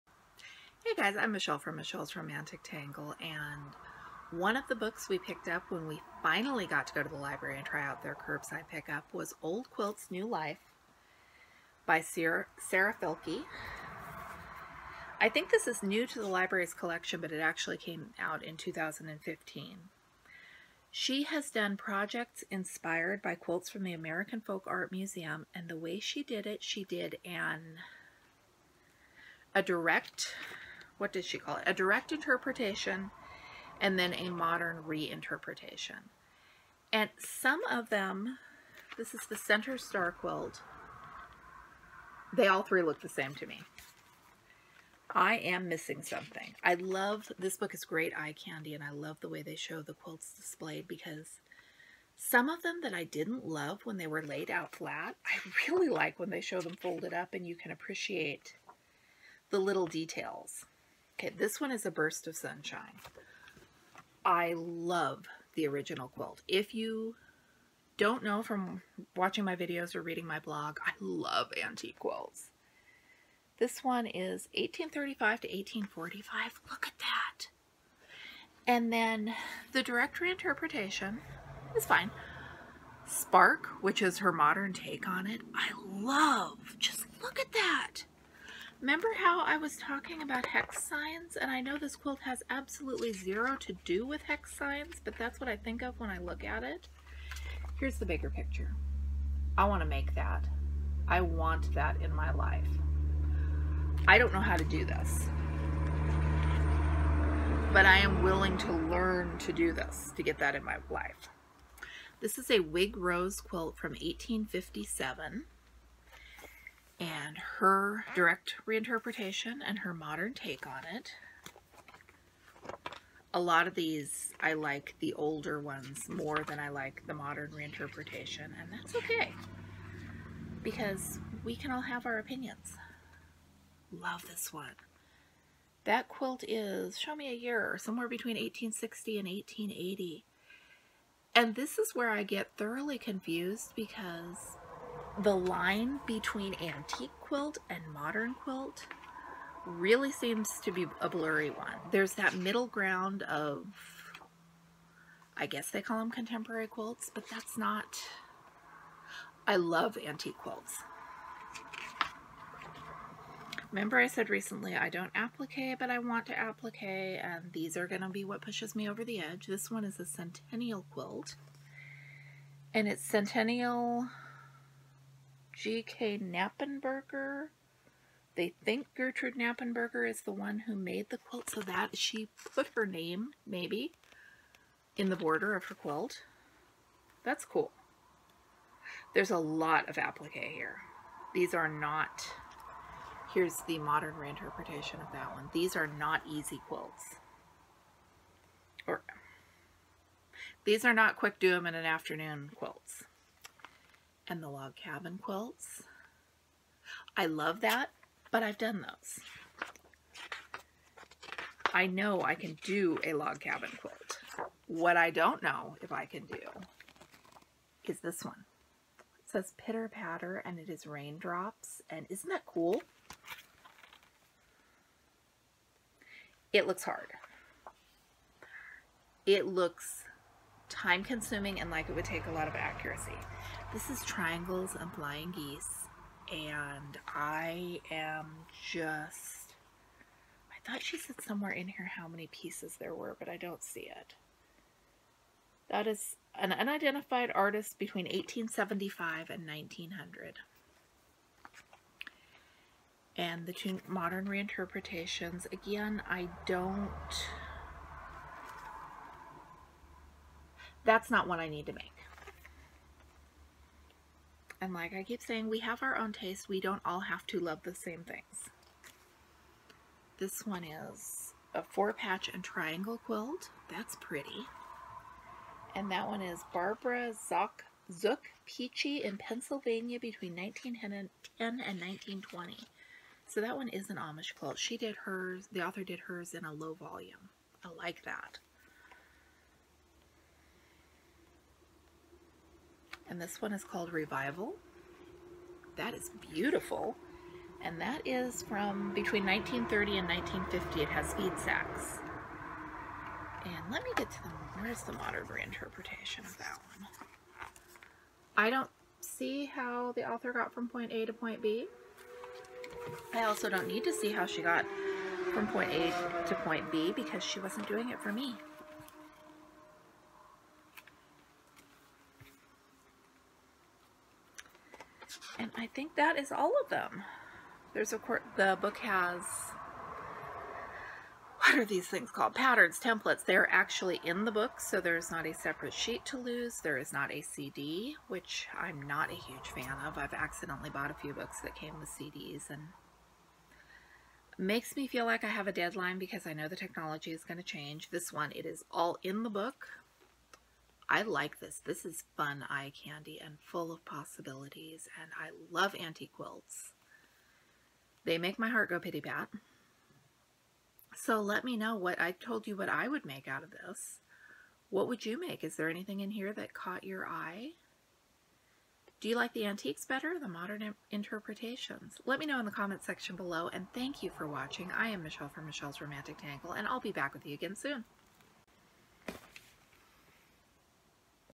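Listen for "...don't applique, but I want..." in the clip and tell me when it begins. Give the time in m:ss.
2:44.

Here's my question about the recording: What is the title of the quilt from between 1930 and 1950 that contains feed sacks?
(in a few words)
Revival.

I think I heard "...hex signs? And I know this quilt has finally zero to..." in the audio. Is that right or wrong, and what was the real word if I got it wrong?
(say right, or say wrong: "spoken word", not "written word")
wrong: "absolutely", not "finally".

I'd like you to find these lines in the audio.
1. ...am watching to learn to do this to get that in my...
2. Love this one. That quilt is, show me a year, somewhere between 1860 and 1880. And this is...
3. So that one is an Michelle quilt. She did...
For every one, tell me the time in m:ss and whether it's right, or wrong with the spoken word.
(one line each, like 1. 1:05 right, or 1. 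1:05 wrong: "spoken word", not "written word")
1. 1:47 wrong: "willing", not "watching"
2. 2:13 right
3. 4:43 wrong: "Amish", not "Michelle".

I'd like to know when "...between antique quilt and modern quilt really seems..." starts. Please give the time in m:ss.
2:26.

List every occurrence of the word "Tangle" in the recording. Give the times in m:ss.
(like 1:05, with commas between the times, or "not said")
0:02, 6:16.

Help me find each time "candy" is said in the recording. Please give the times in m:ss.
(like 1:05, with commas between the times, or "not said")
0:48, 5:52.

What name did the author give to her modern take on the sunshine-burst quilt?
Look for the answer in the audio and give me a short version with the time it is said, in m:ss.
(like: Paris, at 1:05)
Spark, at 1:23.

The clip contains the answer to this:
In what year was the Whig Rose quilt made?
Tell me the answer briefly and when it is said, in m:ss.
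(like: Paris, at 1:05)
1857, at 1:53.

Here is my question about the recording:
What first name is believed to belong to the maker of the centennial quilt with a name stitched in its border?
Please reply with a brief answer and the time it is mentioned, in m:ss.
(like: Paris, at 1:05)
Gertrude, at 2:58.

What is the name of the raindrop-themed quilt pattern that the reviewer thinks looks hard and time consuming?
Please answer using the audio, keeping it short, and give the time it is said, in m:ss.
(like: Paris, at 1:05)
Pitter patter, at 3:39.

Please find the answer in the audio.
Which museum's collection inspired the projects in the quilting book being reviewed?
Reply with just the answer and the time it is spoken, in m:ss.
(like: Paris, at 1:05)
American Folk Art Museum, at 0:23.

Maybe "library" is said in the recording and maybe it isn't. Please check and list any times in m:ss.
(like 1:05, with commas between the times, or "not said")
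0:07, 0:16.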